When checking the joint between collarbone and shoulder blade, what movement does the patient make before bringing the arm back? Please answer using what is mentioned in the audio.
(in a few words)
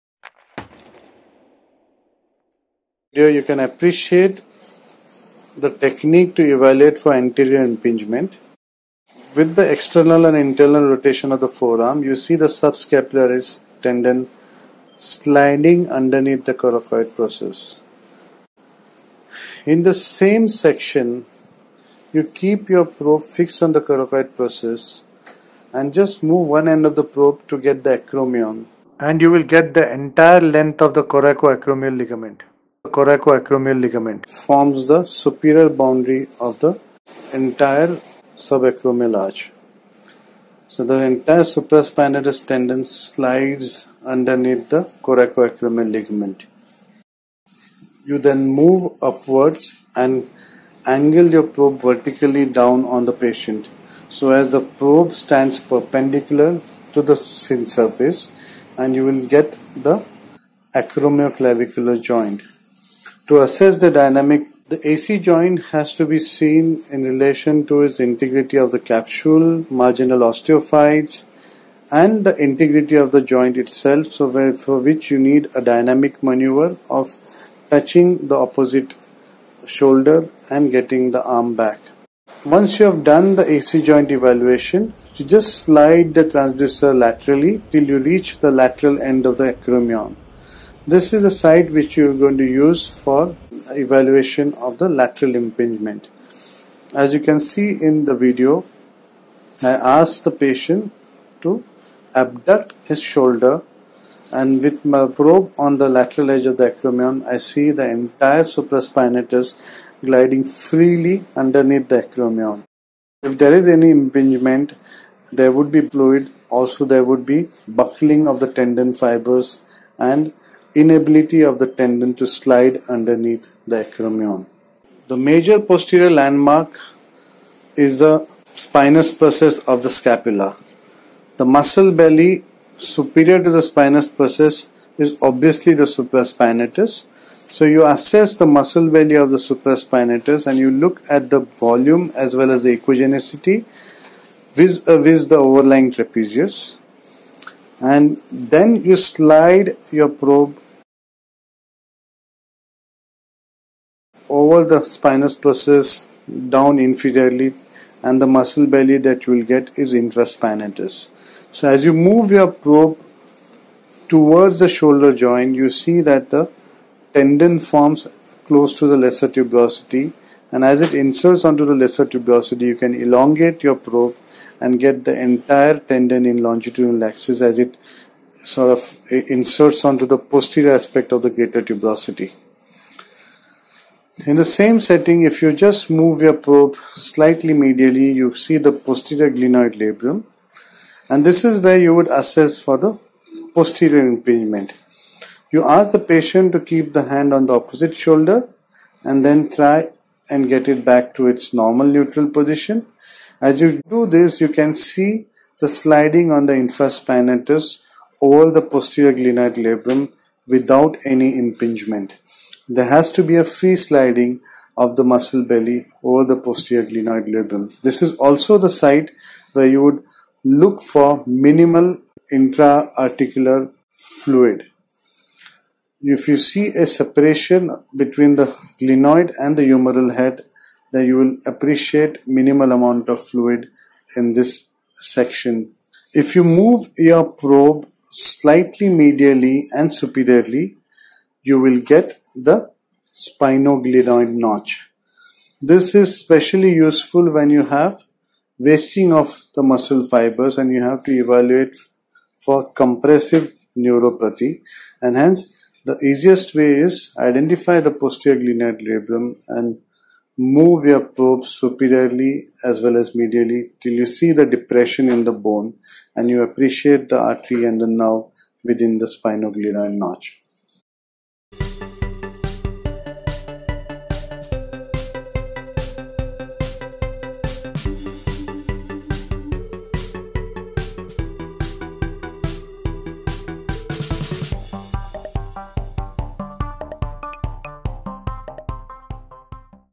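Touching the opposite shoulder.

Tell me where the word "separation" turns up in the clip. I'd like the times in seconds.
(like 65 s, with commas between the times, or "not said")
226 s.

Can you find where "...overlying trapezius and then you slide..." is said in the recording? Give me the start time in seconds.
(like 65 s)
145 s.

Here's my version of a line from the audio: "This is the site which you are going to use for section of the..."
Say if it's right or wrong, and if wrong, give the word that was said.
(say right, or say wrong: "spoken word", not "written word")
wrong: "evaluation", not "section".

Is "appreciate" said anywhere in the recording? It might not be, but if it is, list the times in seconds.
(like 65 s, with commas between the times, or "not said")
3 s, 231 s, 266 s.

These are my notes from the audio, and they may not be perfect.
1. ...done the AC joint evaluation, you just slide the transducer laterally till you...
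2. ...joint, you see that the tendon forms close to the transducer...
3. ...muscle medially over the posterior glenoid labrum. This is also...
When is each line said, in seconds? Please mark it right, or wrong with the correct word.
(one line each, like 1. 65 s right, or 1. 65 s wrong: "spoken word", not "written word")
1. 83 s right
2. 165 s wrong: "lesser", not "transducer"
3. 215 s wrong: "belly", not "medially".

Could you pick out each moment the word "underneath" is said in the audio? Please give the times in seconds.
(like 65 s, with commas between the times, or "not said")
15 s, 44 s, 111 s, 122 s.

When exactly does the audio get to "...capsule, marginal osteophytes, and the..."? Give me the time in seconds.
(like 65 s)
68 s.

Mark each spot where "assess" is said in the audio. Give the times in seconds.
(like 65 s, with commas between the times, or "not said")
63 s, 137 s, 192 s.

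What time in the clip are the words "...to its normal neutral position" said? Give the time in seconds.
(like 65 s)
201 s.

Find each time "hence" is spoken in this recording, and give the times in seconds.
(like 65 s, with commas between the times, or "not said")
255 s.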